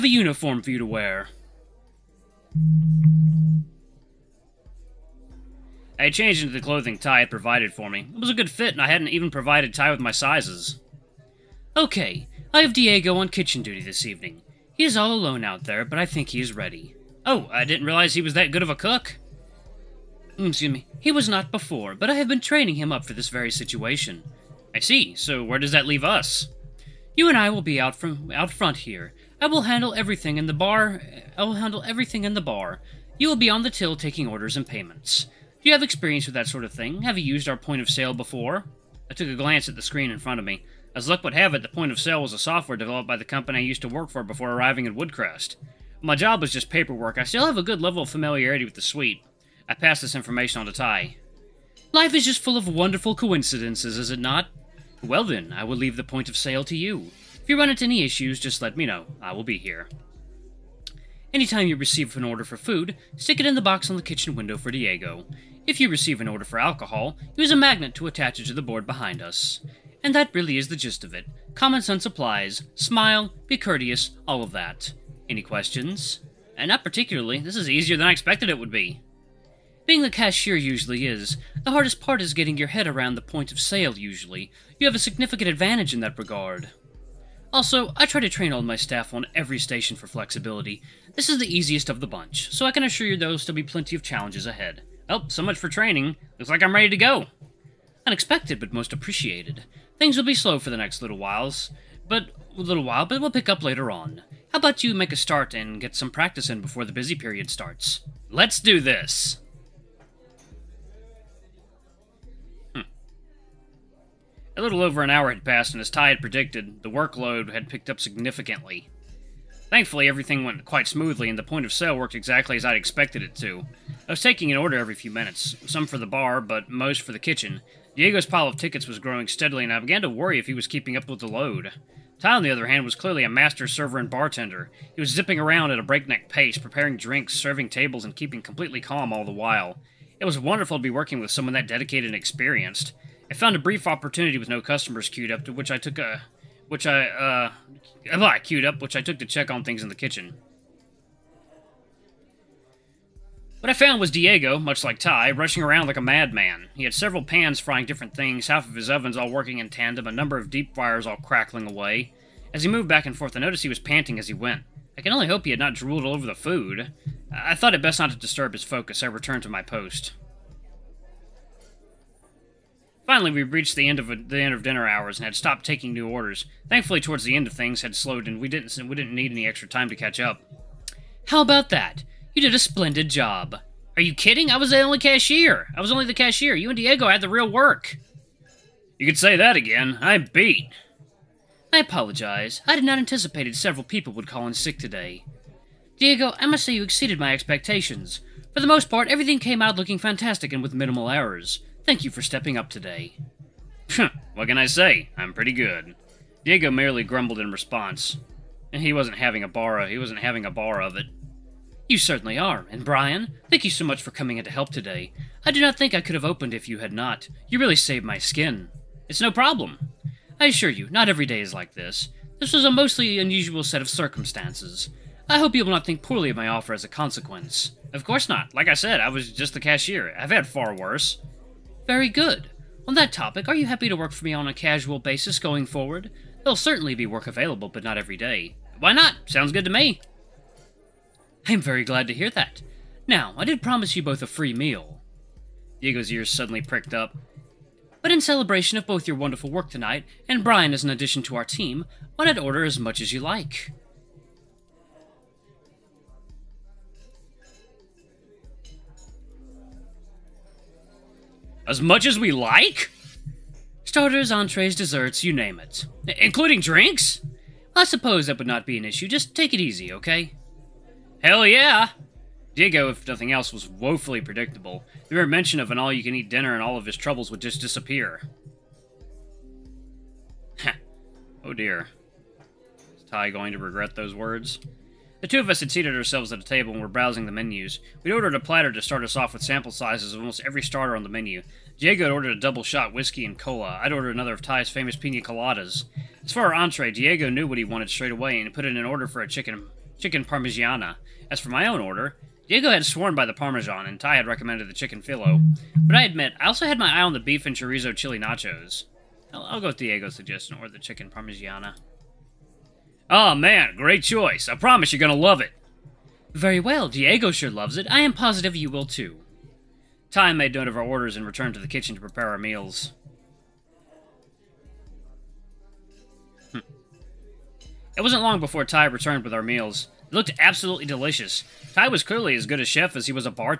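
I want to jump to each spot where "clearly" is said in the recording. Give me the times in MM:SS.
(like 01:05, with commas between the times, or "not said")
02:12, 05:32.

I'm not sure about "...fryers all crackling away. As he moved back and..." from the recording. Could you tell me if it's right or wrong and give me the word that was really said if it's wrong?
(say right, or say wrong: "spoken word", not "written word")
right.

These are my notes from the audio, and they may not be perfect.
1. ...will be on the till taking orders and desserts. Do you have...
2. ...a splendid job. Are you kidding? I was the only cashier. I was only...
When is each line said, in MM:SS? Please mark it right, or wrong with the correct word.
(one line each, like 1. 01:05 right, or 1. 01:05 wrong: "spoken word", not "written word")
1. 00:33 wrong: "payments", not "desserts"
2. 03:02 right.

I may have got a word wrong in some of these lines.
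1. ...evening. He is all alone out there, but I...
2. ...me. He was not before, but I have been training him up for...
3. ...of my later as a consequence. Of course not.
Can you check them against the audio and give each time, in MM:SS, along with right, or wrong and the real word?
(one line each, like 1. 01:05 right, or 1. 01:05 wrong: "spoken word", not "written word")
1. 00:14 right
2. 00:20 right
3. 03:46 wrong: "offer", not "later".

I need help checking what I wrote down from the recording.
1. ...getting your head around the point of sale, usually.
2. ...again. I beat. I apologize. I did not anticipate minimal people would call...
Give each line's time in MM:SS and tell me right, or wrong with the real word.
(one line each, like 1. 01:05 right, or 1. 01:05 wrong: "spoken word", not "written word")
1. 01:22 right
2. 03:09 wrong: "several", not "minimal".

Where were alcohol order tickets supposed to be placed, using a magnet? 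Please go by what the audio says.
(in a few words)
the board behind us.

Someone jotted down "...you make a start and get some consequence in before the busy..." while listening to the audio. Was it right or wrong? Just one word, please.
wrong.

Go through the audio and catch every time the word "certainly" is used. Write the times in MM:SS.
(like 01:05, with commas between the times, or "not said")
03:31, 03:56.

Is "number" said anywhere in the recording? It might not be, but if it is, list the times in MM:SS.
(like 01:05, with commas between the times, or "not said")
02:40.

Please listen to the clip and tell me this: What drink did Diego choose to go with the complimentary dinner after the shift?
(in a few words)
double shot whiskey and cola.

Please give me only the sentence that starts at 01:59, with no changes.
Thankfully, everything went quite smoothly and the point of sale worked exactly as I'd expected it to.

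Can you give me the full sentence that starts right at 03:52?
On that topic, are you happy to work for me on a casual basis going forward?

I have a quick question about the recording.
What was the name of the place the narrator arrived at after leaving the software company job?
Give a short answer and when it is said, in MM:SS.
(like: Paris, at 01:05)
Woodcrest, at 00:44.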